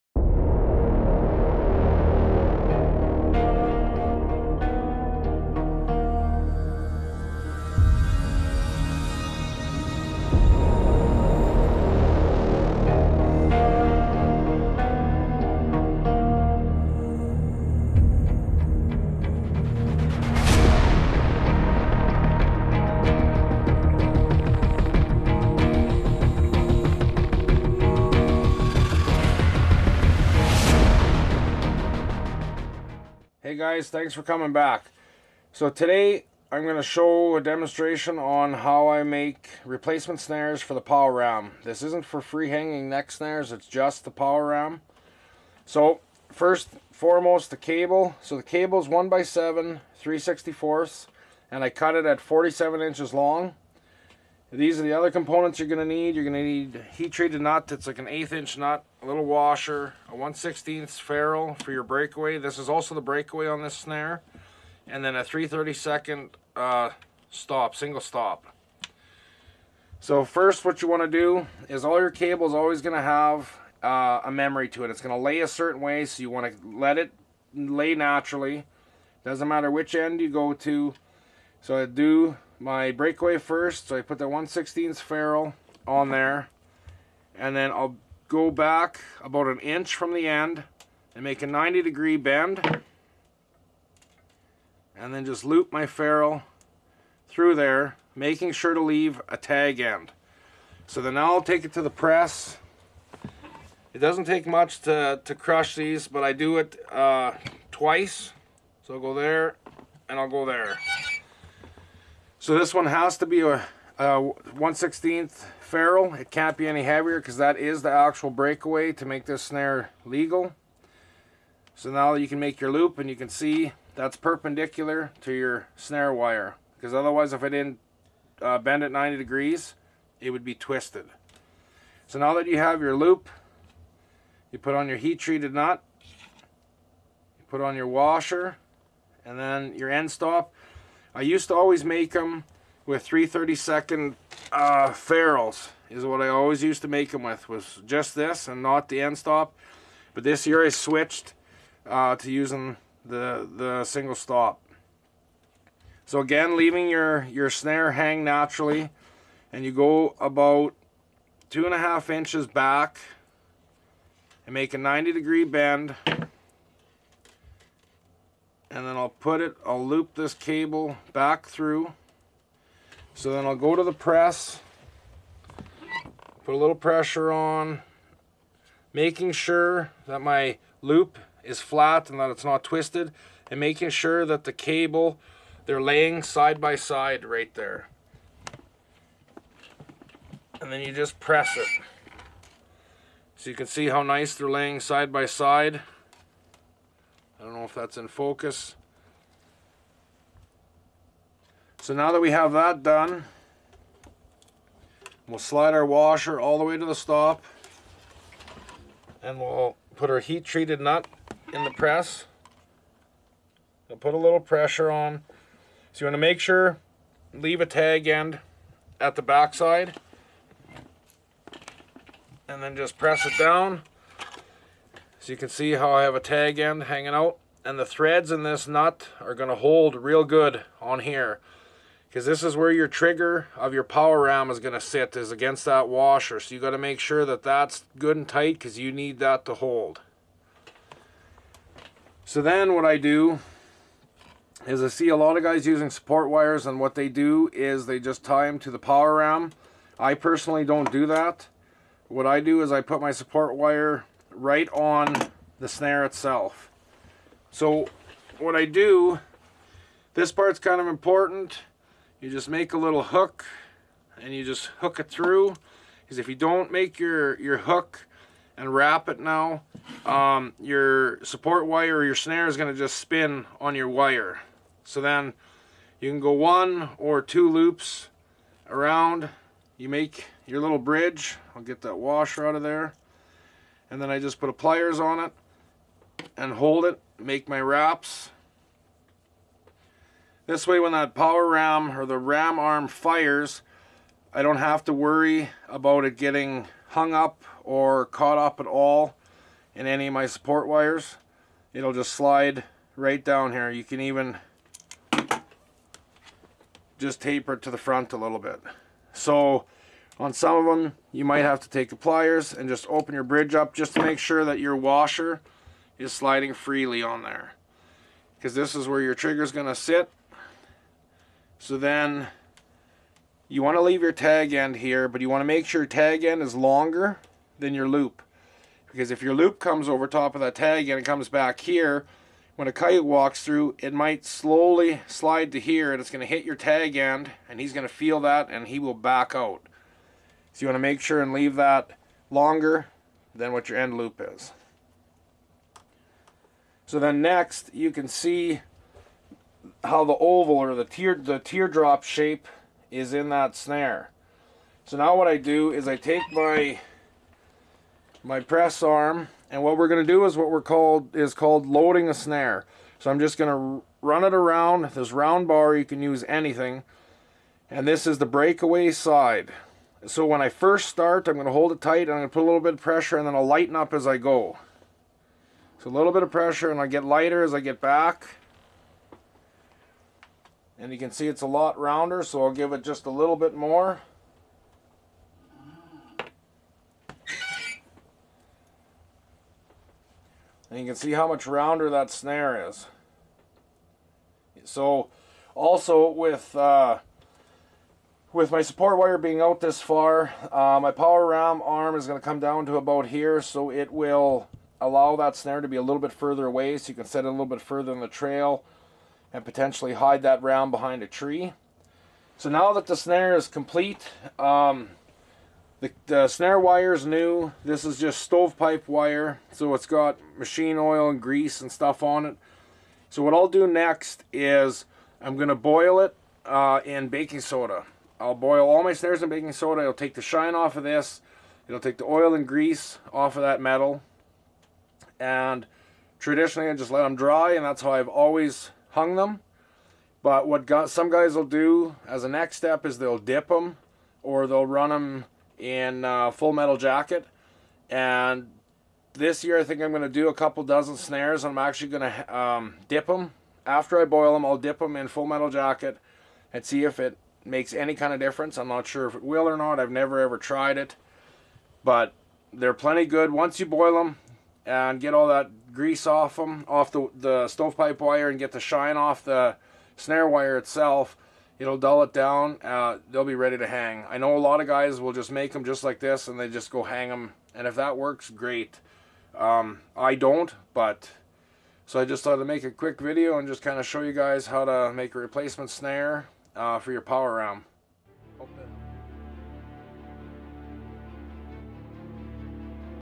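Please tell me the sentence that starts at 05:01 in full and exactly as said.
It'll just slide right down here.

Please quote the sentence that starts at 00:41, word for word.
This isn't for free hanging neck snares, it's just the power ram.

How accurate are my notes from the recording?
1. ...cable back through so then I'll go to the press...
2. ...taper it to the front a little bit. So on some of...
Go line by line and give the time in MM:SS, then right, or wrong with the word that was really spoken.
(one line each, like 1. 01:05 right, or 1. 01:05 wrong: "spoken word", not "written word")
1. 02:50 right
2. 05:07 right.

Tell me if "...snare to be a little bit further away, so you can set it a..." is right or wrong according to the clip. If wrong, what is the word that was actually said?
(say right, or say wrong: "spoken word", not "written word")
right.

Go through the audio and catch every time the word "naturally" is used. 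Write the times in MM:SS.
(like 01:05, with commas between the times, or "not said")
01:17, 02:38.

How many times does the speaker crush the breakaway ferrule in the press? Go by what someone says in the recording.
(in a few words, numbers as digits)
Twice.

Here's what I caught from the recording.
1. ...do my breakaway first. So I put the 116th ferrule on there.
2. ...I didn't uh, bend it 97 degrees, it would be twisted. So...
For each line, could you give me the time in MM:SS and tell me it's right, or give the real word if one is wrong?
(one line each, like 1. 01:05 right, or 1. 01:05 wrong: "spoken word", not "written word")
1. 01:21 right
2. 02:07 wrong: "90", not "97".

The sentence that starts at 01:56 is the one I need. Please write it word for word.
It can't be any heavier because that is the actual breakaway to make this snare legal.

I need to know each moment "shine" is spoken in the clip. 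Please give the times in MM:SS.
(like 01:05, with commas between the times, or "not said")
07:10, 07:48.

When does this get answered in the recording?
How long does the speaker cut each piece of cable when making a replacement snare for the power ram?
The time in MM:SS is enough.
00:52.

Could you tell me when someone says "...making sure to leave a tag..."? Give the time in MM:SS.
01:38.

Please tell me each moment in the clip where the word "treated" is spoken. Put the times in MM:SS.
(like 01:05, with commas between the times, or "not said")
00:57, 02:15, 03:30.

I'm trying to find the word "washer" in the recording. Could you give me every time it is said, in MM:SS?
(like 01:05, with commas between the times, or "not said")
00:59, 02:17, 03:25, 03:55, 04:41, 05:14.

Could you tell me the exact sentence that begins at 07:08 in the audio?
I'll boil all my snares in baking soda.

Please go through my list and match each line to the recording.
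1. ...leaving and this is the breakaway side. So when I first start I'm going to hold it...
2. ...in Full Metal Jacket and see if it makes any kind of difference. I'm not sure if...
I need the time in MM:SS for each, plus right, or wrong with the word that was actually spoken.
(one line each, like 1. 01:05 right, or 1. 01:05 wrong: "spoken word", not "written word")
1. 06:06 wrong: "anything", not "leaving"
2. 07:34 right.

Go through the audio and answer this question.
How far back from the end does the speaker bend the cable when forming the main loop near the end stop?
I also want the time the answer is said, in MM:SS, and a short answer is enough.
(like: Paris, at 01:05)
Two and a half inches, at 02:41.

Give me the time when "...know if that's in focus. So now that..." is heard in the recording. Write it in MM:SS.
03:17.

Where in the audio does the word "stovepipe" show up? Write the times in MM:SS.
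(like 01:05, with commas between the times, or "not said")
06:58, 07:47.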